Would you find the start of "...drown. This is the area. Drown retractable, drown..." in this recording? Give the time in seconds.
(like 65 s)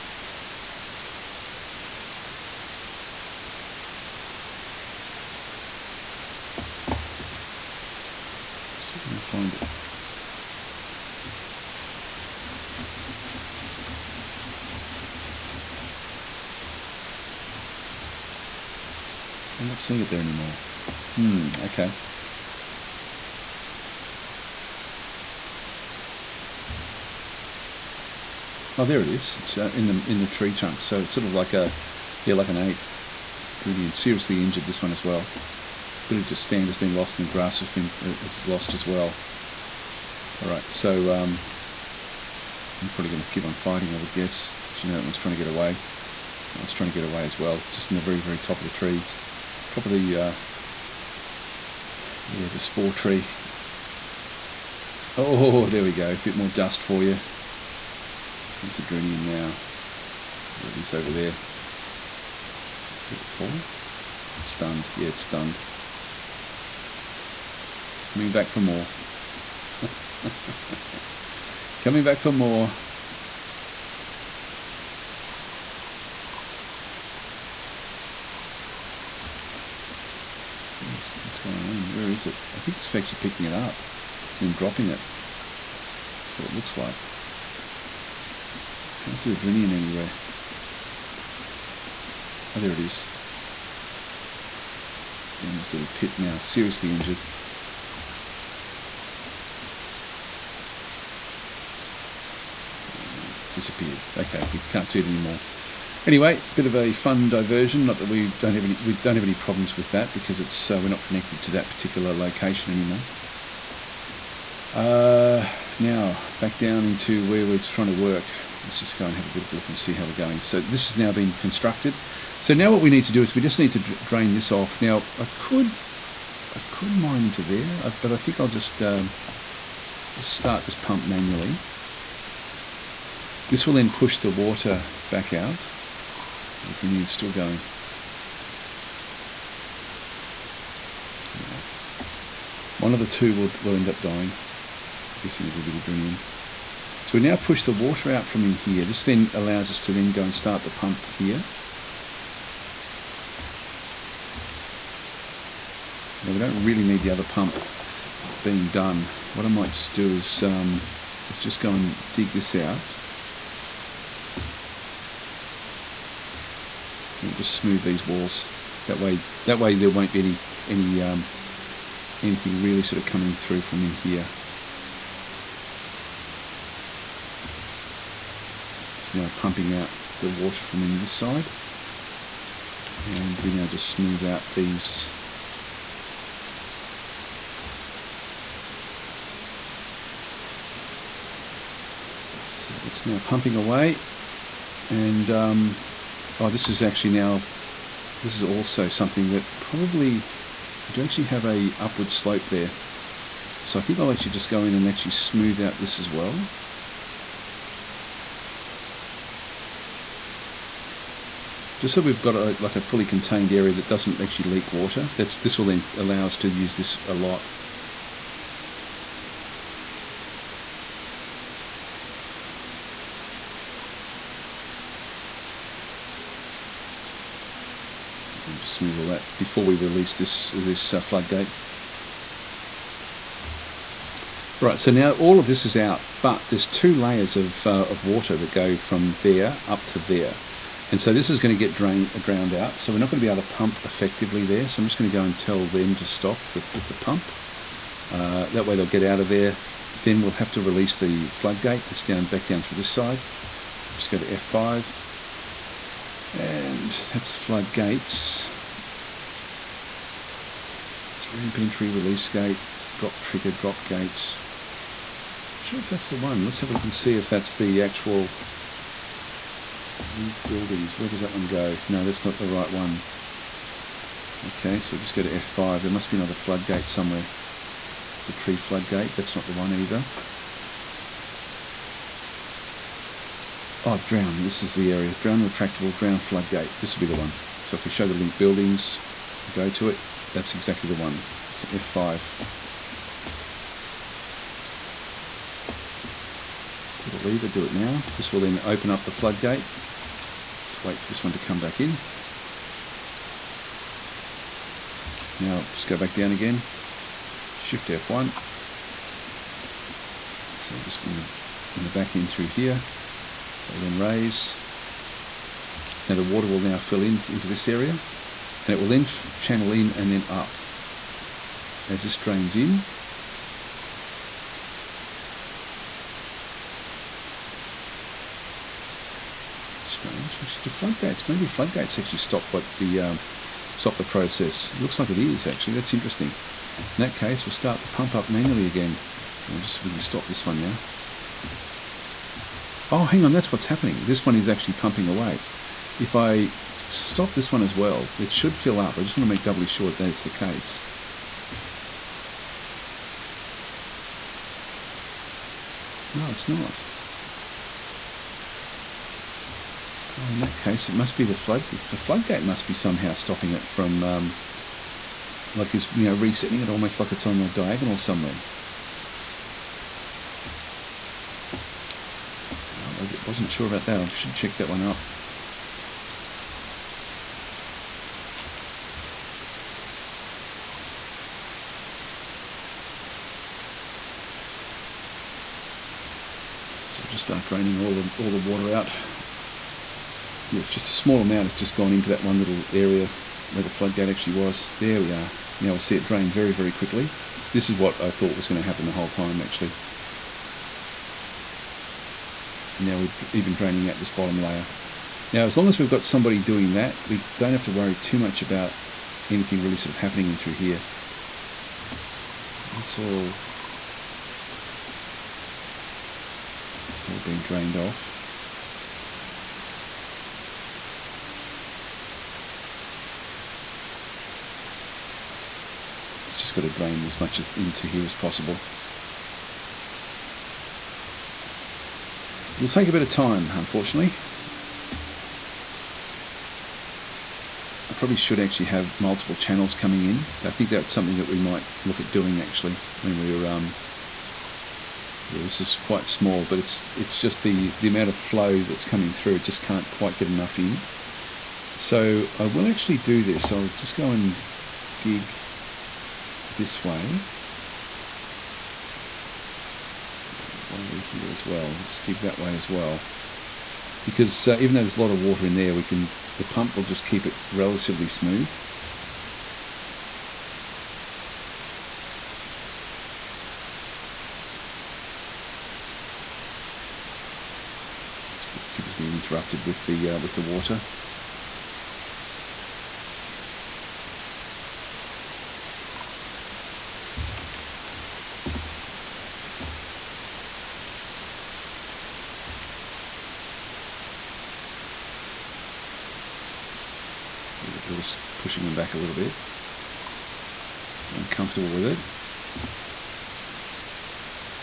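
283 s.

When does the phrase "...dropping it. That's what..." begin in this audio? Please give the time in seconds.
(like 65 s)
84 s.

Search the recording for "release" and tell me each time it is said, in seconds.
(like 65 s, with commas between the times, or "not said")
229 s, 250 s, 261 s.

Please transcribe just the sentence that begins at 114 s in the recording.
Uh, now back down into where we're trying to work.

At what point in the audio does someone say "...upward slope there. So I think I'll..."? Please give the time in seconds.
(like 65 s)
201 s.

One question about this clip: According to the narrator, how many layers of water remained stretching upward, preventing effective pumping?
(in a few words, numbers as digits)
2.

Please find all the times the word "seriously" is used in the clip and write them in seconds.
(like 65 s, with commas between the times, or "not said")
33 s, 96 s.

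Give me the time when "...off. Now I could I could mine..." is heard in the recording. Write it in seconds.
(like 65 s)
124 s.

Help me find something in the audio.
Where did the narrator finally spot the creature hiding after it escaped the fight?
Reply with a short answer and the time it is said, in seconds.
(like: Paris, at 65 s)
In the tree trunk, at 30 s.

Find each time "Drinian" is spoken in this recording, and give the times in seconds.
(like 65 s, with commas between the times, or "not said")
89 s, 136 s, 145 s.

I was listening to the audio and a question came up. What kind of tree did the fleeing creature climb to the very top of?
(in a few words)
Spore tree.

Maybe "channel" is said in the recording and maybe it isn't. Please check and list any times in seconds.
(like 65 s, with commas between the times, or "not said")
319 s, 439 s.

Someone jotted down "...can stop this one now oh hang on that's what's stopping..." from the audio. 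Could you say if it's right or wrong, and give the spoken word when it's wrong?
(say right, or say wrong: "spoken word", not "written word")
wrong: "happening", not "stopping".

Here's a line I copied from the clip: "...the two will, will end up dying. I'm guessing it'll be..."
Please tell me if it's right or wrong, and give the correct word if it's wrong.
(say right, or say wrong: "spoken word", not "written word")
right.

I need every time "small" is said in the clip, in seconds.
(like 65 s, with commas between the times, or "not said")
390 s, 446 s.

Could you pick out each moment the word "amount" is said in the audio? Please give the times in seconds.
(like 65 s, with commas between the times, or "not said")
391 s, 447 s.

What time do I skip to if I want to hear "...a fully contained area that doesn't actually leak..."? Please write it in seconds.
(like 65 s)
212 s.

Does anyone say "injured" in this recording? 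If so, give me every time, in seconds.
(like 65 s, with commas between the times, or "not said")
34 s, 96 s.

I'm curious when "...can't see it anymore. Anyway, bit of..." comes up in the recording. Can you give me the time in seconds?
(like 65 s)
104 s.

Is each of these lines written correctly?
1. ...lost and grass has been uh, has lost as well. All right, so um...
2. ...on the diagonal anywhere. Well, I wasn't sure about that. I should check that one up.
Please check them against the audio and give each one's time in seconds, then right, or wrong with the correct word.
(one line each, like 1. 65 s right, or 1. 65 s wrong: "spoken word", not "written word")
1. 36 s right
2. 367 s wrong: "somewhere", not "anywhere".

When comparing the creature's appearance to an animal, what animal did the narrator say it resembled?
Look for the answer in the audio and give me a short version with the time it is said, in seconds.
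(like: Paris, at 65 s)
An ape, at 32 s.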